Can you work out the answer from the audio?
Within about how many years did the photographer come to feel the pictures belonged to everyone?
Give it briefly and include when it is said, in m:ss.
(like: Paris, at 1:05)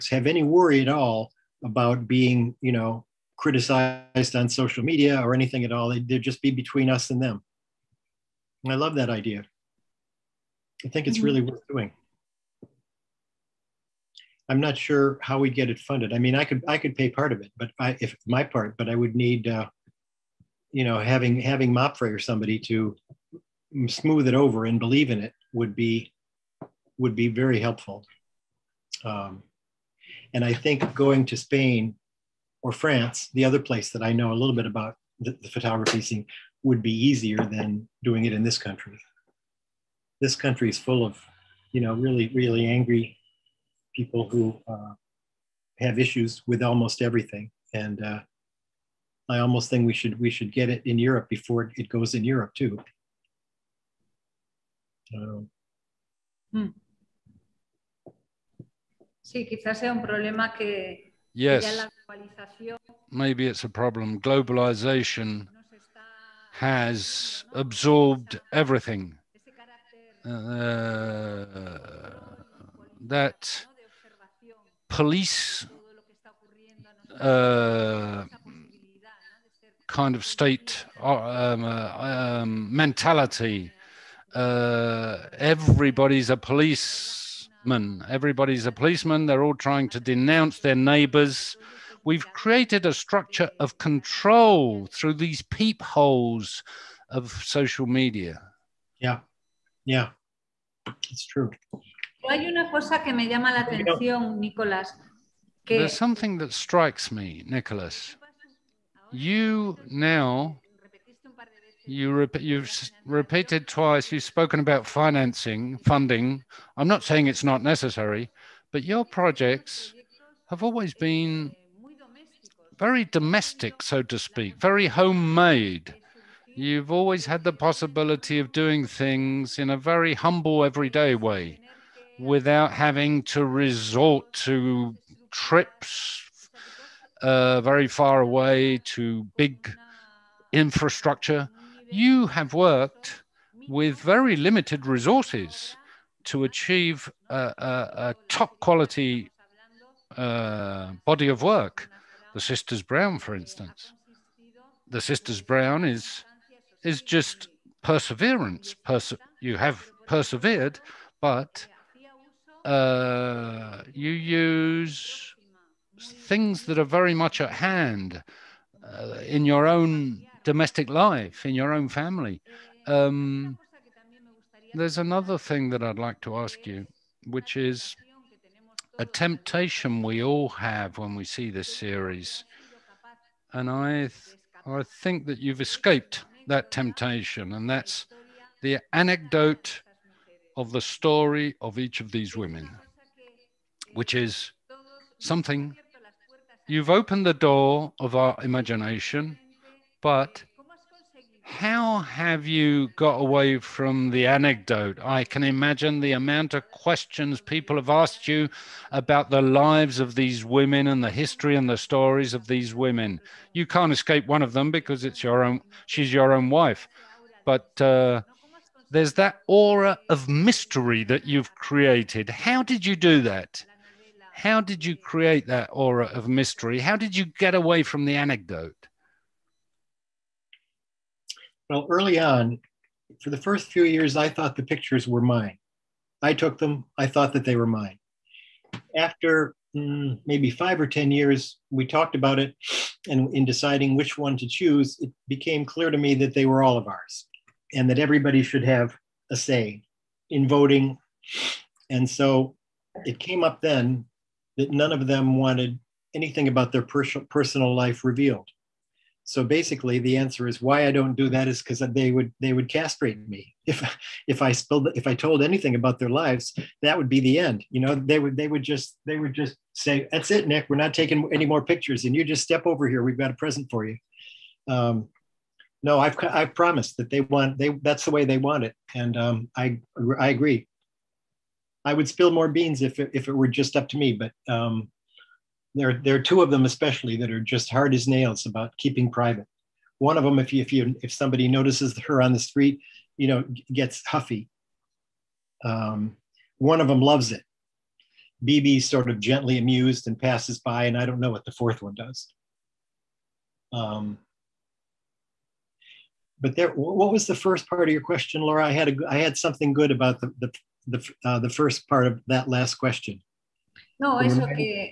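10 years, at 4:00.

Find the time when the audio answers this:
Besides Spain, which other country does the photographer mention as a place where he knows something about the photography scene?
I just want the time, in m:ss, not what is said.
0:32.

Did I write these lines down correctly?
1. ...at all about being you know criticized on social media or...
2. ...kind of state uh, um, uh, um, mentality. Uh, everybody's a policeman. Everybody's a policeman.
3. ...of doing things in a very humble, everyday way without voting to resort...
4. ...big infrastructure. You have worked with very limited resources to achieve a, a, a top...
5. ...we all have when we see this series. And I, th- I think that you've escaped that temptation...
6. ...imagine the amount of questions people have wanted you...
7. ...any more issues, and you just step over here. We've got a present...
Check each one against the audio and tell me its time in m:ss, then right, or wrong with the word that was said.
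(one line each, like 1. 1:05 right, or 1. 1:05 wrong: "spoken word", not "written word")
1. 0:00 right
2. 1:19 right
3. 2:08 wrong: "having", not "voting"
4. 2:19 right
5. 3:00 right
6. 3:25 wrong: "asked", not "wanted"
7. 4:31 wrong: "pictures", not "issues".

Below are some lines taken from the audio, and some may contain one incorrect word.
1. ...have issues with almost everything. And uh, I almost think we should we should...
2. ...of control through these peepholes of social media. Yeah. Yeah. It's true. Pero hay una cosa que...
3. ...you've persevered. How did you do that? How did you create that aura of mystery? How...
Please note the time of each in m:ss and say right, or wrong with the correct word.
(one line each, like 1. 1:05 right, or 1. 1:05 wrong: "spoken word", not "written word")
1. 0:45 right
2. 1:33 right
3. 3:41 wrong: "created", not "persevered".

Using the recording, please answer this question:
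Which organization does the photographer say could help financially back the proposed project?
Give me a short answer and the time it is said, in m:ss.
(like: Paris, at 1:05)
MAPFRE, at 0:21.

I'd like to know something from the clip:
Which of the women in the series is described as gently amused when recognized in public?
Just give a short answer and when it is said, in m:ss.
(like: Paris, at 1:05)
Bebe, at 4:58.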